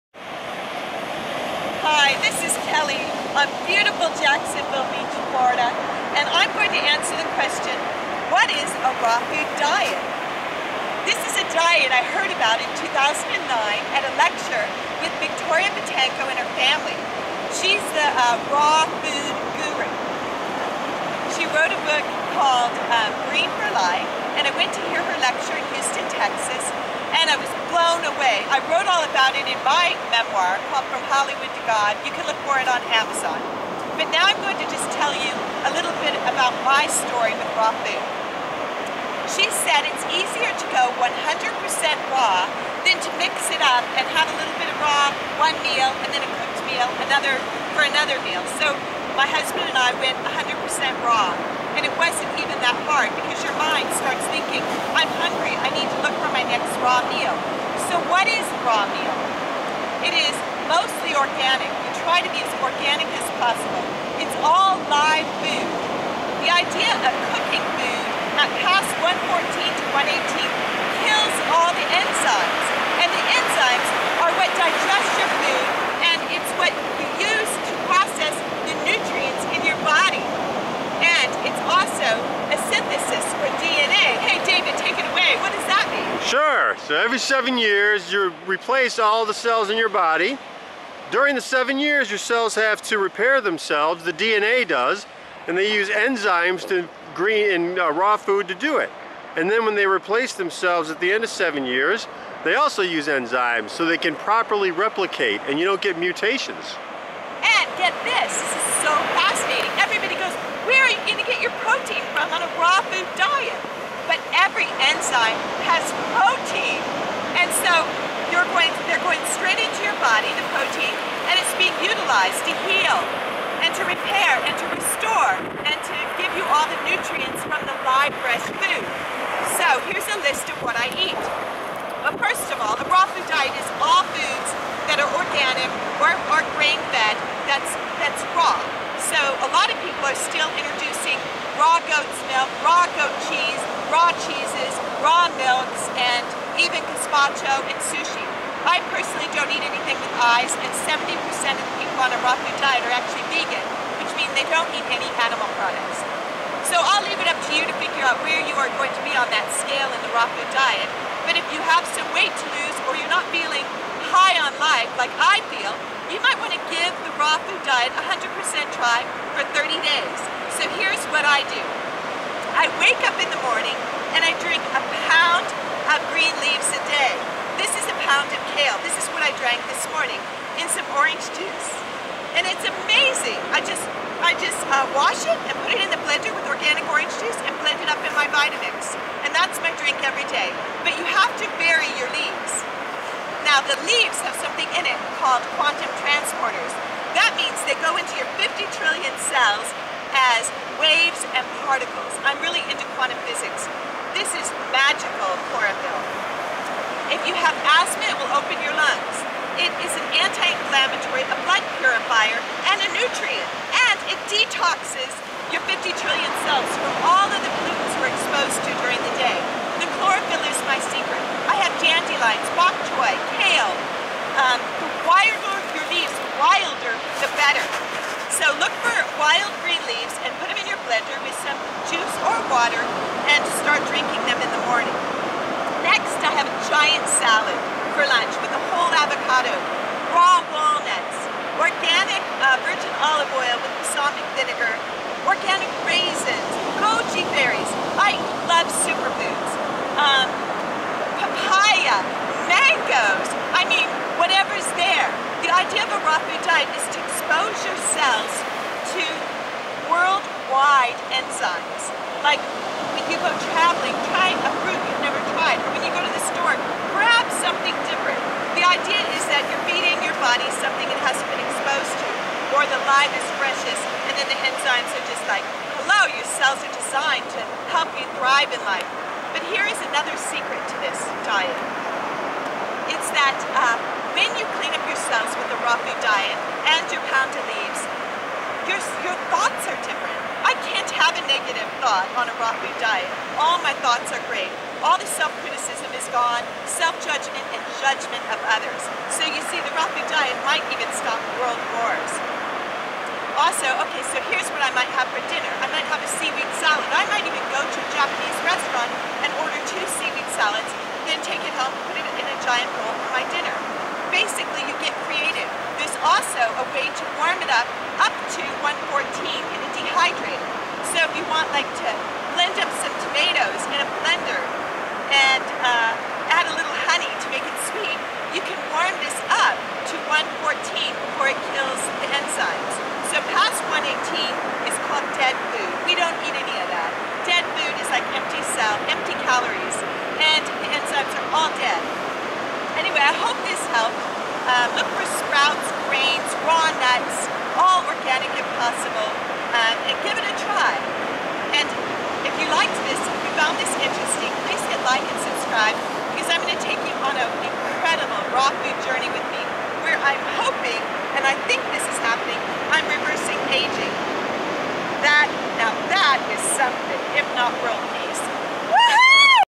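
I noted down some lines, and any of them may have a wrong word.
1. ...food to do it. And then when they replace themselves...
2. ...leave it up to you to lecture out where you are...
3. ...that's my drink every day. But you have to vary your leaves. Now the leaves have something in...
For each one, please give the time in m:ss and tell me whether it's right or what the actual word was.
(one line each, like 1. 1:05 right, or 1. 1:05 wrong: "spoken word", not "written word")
1. 1:38 right
2. 2:37 wrong: "figure", not "lecture"
3. 3:09 right.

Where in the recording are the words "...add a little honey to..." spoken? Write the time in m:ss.
5:26.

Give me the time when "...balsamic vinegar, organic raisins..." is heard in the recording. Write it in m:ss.
4:03.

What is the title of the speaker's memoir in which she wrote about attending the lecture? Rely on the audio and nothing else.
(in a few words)
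From Hollywood to God.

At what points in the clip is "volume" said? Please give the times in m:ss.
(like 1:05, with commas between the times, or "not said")
not said.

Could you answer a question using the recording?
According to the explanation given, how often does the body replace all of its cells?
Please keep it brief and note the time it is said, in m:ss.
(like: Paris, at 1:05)
every 7 years, at 1:26.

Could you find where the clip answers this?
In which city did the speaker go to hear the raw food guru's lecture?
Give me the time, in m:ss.
0:25.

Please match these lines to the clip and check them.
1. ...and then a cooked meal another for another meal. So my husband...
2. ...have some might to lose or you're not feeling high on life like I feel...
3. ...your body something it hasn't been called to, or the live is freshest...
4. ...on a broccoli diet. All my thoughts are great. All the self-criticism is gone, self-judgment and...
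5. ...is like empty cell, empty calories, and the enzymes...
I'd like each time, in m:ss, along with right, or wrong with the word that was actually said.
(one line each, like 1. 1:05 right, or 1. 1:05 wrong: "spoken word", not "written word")
1. 0:46 right
2. 2:41 wrong: "weight", not "might"
3. 4:30 wrong: "exposed", not "called"
4. 4:52 right
5. 5:37 right.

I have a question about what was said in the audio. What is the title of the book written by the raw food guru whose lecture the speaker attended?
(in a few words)
Green for Life.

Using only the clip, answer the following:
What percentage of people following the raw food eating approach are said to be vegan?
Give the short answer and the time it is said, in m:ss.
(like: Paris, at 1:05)
70%, at 2:30.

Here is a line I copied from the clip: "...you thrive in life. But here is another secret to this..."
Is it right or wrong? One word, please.
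right.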